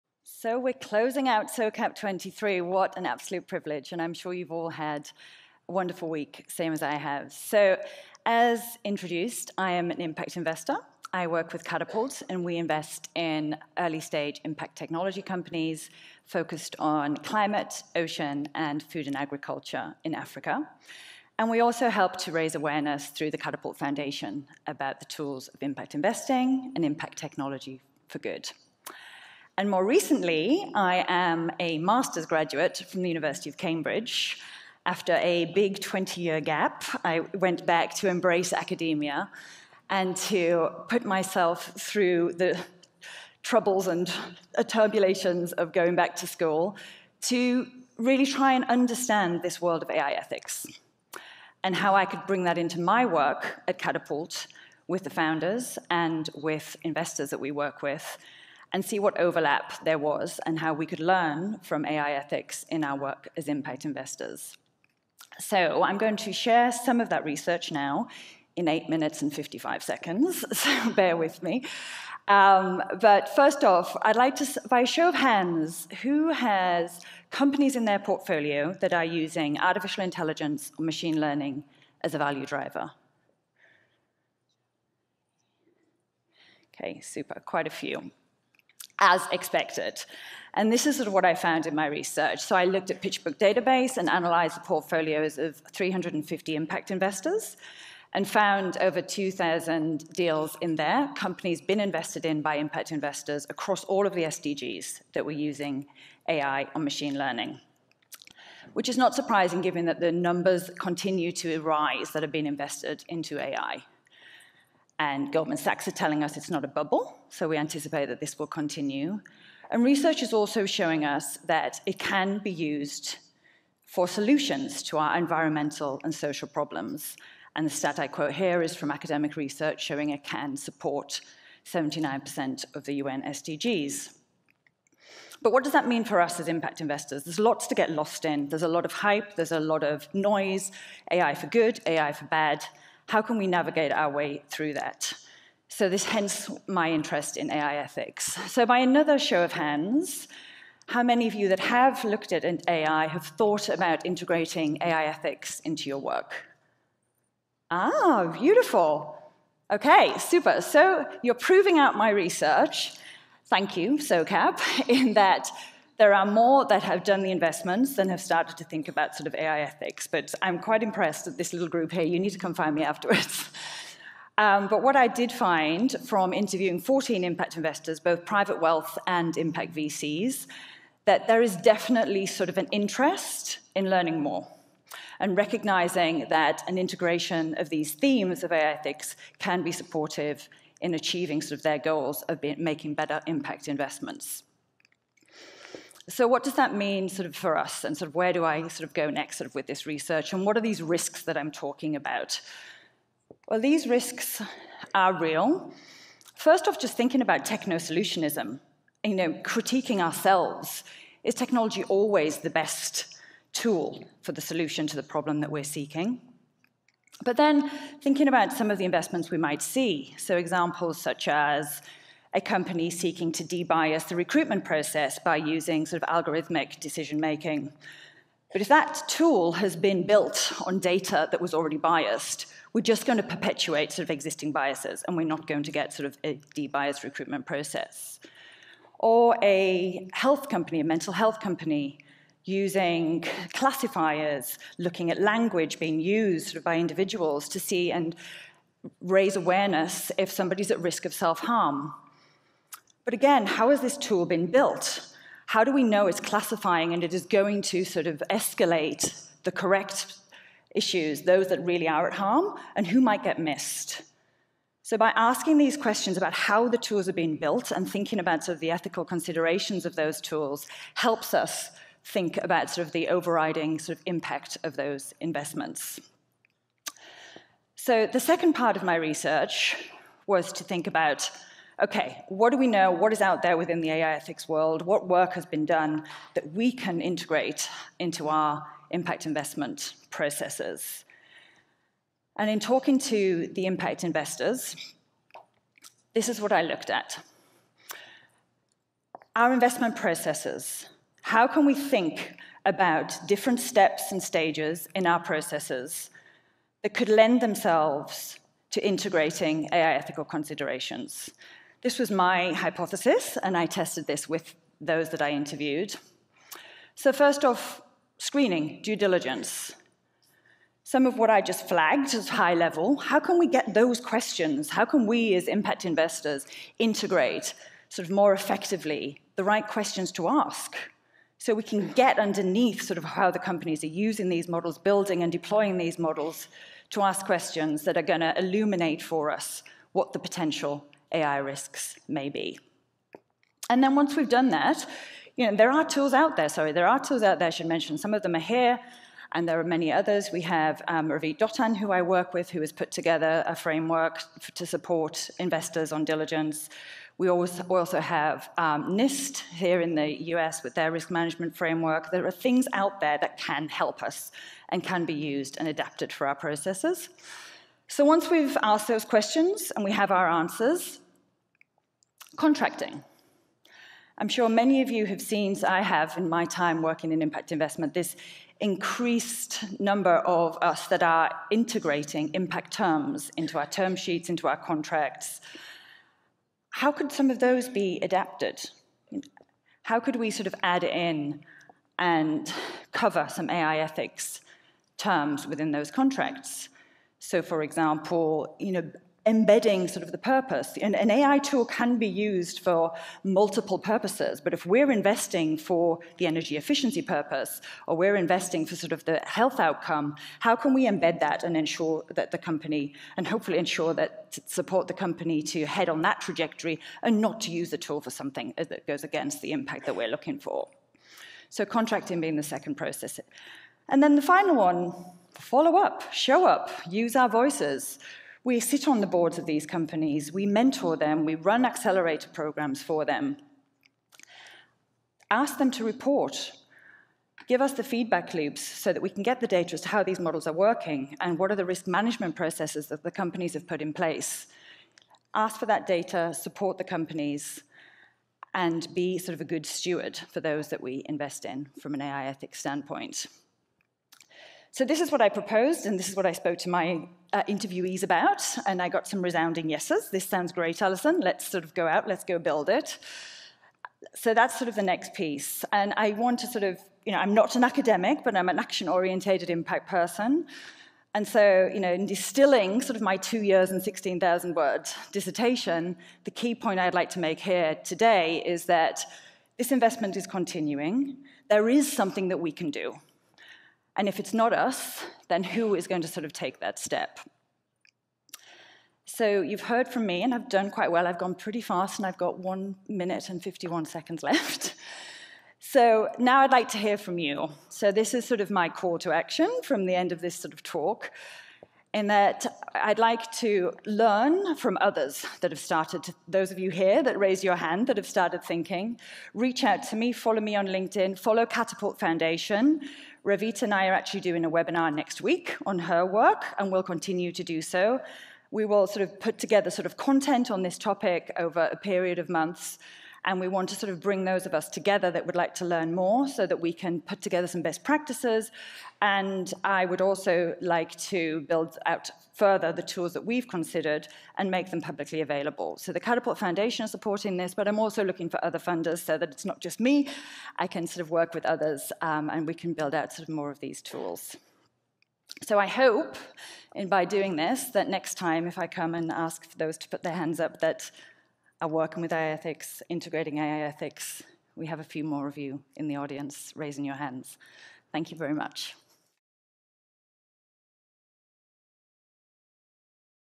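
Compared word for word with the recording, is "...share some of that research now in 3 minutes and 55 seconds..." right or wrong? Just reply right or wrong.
wrong.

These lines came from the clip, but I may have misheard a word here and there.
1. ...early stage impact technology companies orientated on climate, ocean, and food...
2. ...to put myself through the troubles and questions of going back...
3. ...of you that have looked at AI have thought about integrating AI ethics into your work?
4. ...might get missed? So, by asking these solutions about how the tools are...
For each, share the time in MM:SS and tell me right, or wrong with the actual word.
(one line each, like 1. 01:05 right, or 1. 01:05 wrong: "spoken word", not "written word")
1. 00:13 wrong: "focused", not "orientated"
2. 00:40 wrong: "turbulations", not "questions"
3. 02:31 right
4. 04:23 wrong: "questions", not "solutions".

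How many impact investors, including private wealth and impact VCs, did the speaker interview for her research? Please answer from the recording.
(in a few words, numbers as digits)
14.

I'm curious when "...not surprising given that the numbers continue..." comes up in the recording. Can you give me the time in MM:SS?
01:48.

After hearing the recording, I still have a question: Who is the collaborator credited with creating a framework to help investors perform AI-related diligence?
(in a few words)
Ravit Dotan.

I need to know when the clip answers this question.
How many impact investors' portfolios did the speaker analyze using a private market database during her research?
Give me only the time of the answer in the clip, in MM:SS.
01:35.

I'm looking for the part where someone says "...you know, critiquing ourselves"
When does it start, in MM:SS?
03:29.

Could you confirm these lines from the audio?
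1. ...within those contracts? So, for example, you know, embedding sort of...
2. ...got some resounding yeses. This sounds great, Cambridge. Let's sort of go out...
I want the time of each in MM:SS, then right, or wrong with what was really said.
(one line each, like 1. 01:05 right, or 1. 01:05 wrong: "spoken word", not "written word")
1. 06:35 right
2. 07:38 wrong: "Alison", not "Cambridge".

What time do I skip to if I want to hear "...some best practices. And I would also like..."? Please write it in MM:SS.
08:47.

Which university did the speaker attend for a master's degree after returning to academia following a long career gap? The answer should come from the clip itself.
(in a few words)
University of Cambridge.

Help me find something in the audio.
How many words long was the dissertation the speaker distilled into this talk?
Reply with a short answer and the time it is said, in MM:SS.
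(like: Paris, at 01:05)
16,000, at 07:53.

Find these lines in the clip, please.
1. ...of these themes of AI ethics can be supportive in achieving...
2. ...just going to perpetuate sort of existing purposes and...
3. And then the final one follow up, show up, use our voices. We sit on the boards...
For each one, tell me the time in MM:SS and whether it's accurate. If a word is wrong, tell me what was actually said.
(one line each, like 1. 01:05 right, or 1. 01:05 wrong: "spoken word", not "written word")
1. 03:07 right
2. 03:52 wrong: "biases", not "purposes"
3. 07:03 right.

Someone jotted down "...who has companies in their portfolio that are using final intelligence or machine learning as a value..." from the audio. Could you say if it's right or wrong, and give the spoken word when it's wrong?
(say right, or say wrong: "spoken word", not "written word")
wrong: "artificial", not "final".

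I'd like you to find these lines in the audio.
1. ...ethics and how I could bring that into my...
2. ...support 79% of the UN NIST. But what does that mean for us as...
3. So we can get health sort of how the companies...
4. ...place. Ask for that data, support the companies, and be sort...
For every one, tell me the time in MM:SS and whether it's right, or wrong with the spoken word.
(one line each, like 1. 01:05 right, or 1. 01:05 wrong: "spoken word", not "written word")
1. 00:50 right
2. 02:10 wrong: "SDGs", not "NIST"
3. 05:31 wrong: "underneath", not "health"
4. 07:23 right.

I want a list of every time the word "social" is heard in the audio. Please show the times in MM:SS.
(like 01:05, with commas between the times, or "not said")
02:06.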